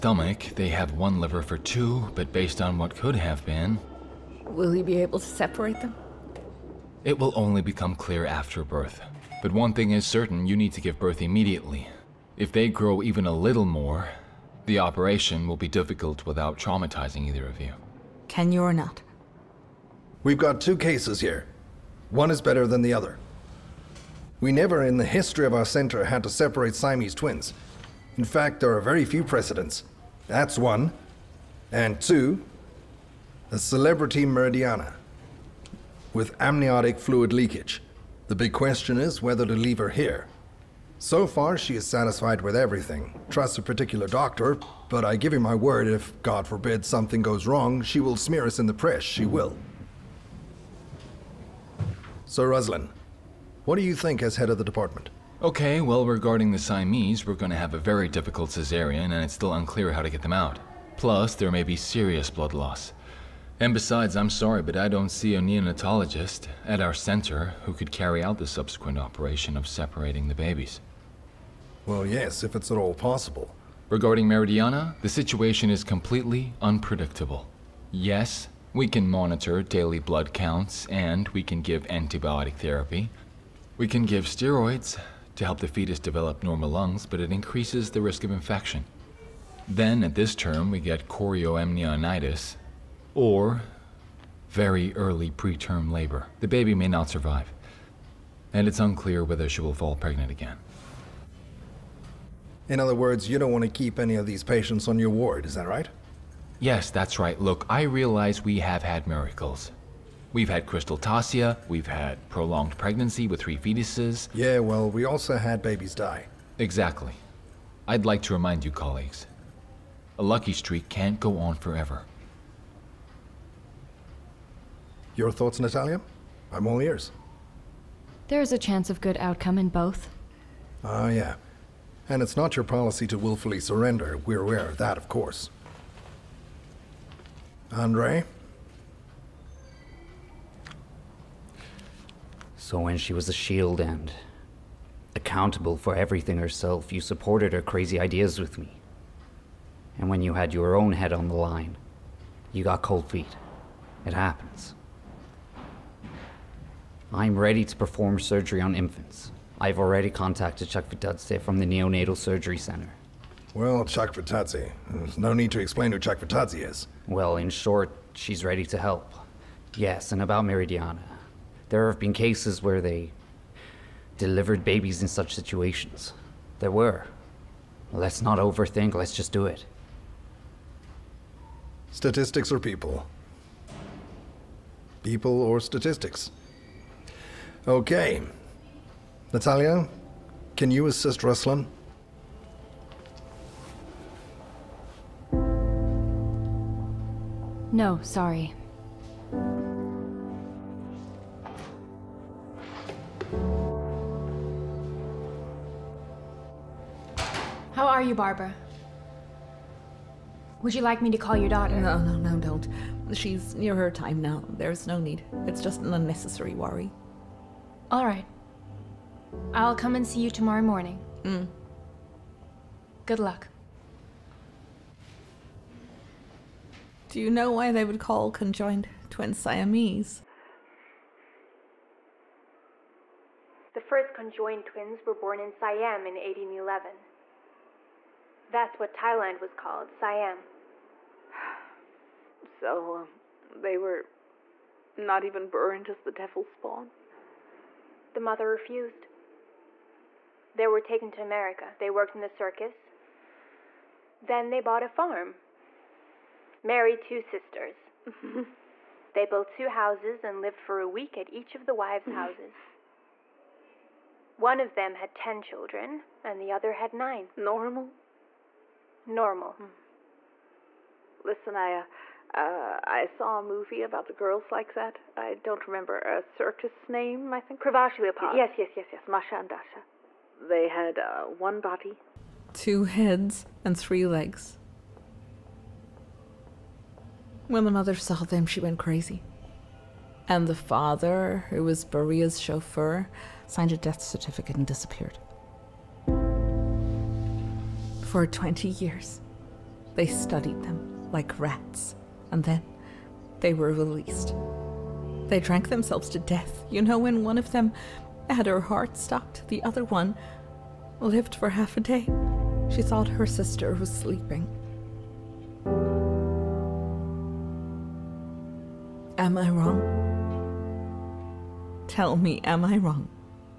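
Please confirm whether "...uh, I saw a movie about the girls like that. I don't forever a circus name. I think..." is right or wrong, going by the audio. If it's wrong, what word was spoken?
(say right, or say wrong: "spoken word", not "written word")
wrong: "remember", not "forever".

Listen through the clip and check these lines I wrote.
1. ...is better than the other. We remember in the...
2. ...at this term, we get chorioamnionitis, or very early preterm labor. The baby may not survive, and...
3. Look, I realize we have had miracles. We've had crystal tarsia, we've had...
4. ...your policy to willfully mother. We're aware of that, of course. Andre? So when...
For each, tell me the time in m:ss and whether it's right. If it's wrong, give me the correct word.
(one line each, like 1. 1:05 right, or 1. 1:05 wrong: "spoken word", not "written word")
1. 0:22 wrong: "never", not "remember"
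2. 1:30 right
3. 1:47 right
4. 2:12 wrong: "surrender", not "mother".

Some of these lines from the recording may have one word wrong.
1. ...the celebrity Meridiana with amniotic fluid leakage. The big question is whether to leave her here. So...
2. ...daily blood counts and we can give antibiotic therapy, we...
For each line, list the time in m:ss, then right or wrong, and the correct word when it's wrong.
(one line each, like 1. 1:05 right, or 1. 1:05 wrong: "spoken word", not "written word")
1. 0:33 right
2. 1:19 right.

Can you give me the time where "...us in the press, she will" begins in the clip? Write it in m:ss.
0:48.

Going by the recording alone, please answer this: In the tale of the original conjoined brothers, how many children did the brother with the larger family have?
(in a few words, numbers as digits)
10.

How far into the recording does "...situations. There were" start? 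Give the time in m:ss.
2:55.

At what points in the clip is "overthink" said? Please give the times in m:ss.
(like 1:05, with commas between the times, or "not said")
2:58.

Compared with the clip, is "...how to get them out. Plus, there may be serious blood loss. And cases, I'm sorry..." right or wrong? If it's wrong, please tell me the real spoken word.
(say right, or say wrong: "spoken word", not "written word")
wrong: "besides", not "cases".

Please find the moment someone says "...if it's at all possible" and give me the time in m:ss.
1:12.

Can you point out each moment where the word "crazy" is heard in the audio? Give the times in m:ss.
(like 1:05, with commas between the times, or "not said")
2:27, 4:48.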